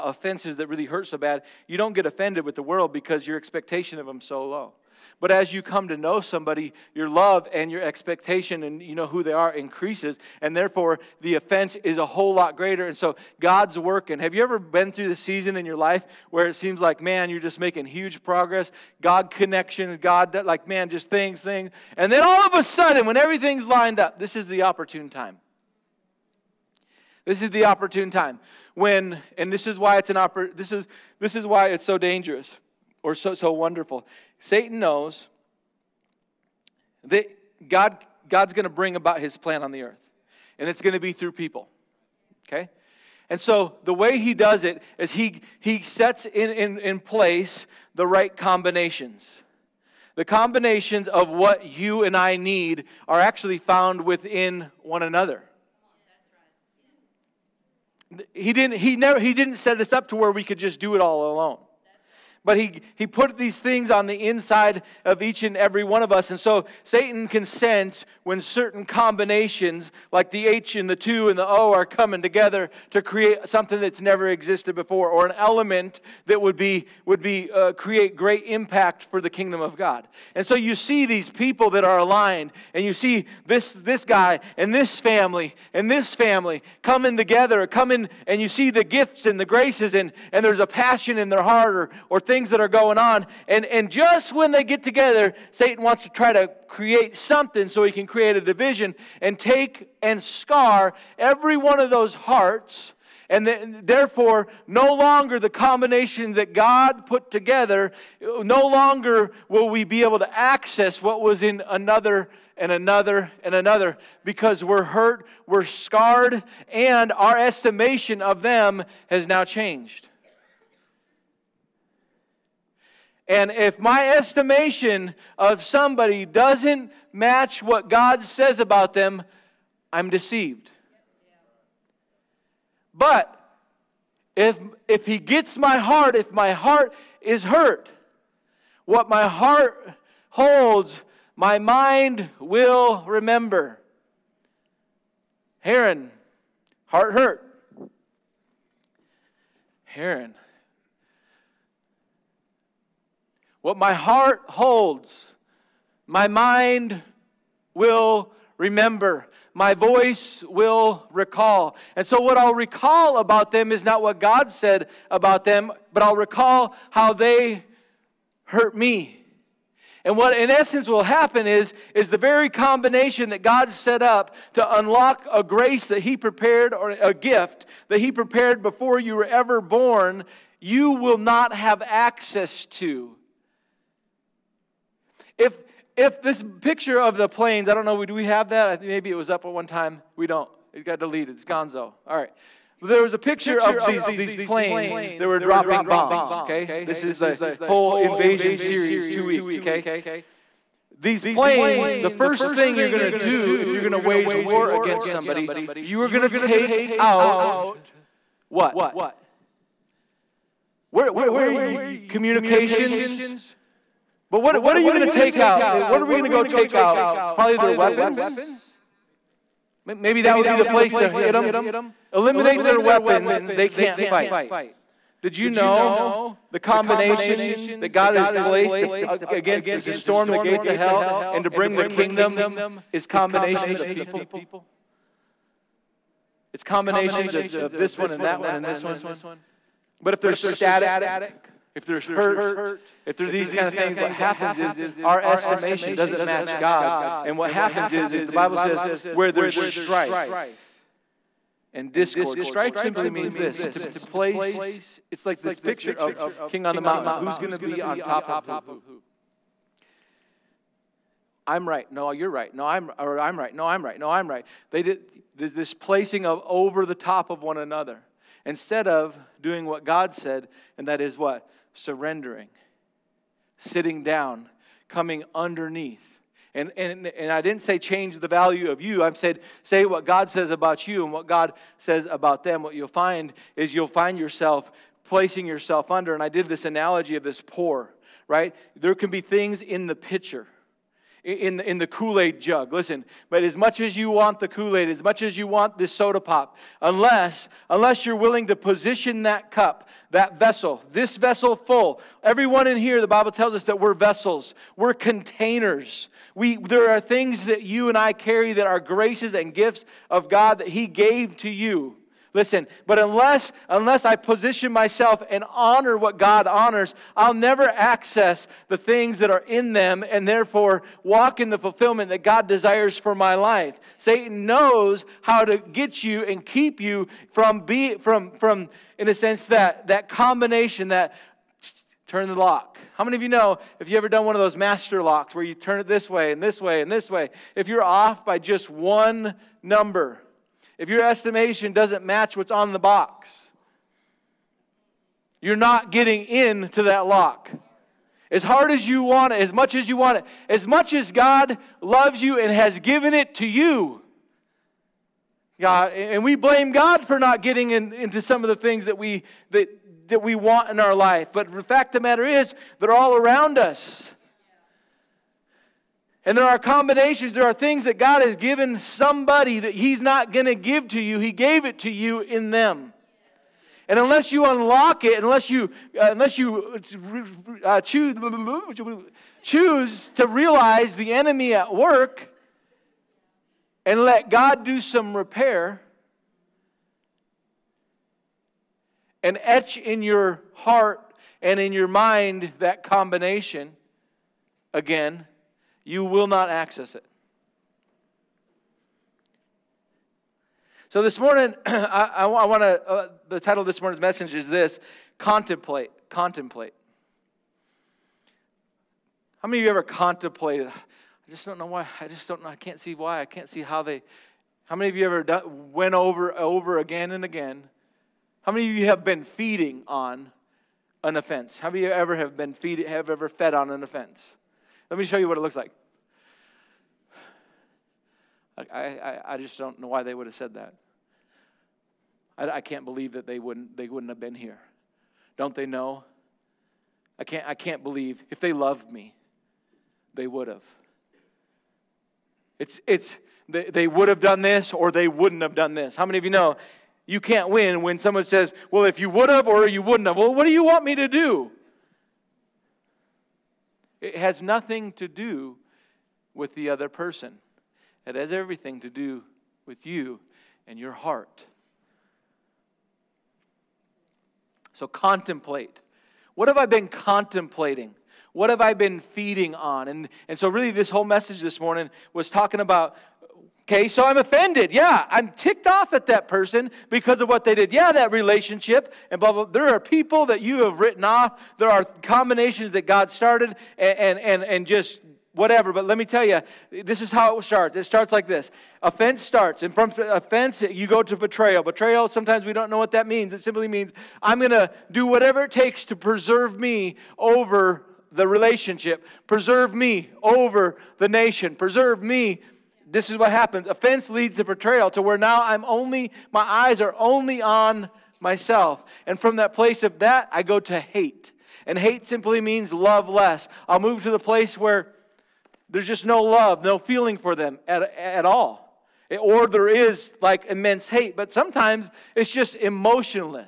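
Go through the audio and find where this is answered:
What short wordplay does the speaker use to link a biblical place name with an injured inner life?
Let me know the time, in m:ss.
2:25.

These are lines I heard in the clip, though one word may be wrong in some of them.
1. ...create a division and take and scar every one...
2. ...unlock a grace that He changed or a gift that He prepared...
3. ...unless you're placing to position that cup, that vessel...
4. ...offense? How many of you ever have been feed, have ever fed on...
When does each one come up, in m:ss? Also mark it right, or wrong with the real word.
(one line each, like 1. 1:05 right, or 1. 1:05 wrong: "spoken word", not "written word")
1. 1:38 right
2. 2:54 wrong: "prepared", not "changed"
3. 4:57 wrong: "willing", not "placing"
4. 7:01 right.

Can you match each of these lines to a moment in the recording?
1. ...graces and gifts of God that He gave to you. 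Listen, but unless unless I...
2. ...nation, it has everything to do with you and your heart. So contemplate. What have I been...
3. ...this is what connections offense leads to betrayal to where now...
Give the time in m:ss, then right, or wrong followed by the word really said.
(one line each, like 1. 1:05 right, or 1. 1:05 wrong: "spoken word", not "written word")
1. 5:08 right
2. 7:36 wrong: "person", not "nation"
3. 8:22 wrong: "happens", not "connections".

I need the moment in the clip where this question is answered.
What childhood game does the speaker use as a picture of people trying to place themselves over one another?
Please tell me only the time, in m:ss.
4:16.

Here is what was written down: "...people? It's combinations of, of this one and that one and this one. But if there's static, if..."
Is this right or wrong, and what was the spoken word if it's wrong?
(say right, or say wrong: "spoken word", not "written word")
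right.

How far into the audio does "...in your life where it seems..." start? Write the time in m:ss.
0:15.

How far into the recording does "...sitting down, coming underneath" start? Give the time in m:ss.
4:33.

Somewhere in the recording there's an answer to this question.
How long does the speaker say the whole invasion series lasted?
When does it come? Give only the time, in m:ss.
3:19.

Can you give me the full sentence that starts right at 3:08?
Maybe it was up at one time.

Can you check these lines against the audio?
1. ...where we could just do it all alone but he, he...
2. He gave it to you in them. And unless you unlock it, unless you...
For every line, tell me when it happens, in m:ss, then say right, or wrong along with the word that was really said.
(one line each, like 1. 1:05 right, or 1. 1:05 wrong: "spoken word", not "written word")
1. 1:00 right
2. 6:11 right.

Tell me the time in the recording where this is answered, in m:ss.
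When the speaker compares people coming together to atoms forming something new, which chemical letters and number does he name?
1:10.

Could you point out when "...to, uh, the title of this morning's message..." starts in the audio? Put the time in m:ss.
6:42.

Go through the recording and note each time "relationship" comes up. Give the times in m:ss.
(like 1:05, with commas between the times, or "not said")
7:58, 8:18.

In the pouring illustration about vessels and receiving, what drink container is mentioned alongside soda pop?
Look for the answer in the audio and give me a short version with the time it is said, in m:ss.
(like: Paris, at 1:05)
Kool Aid jug, at 4:51.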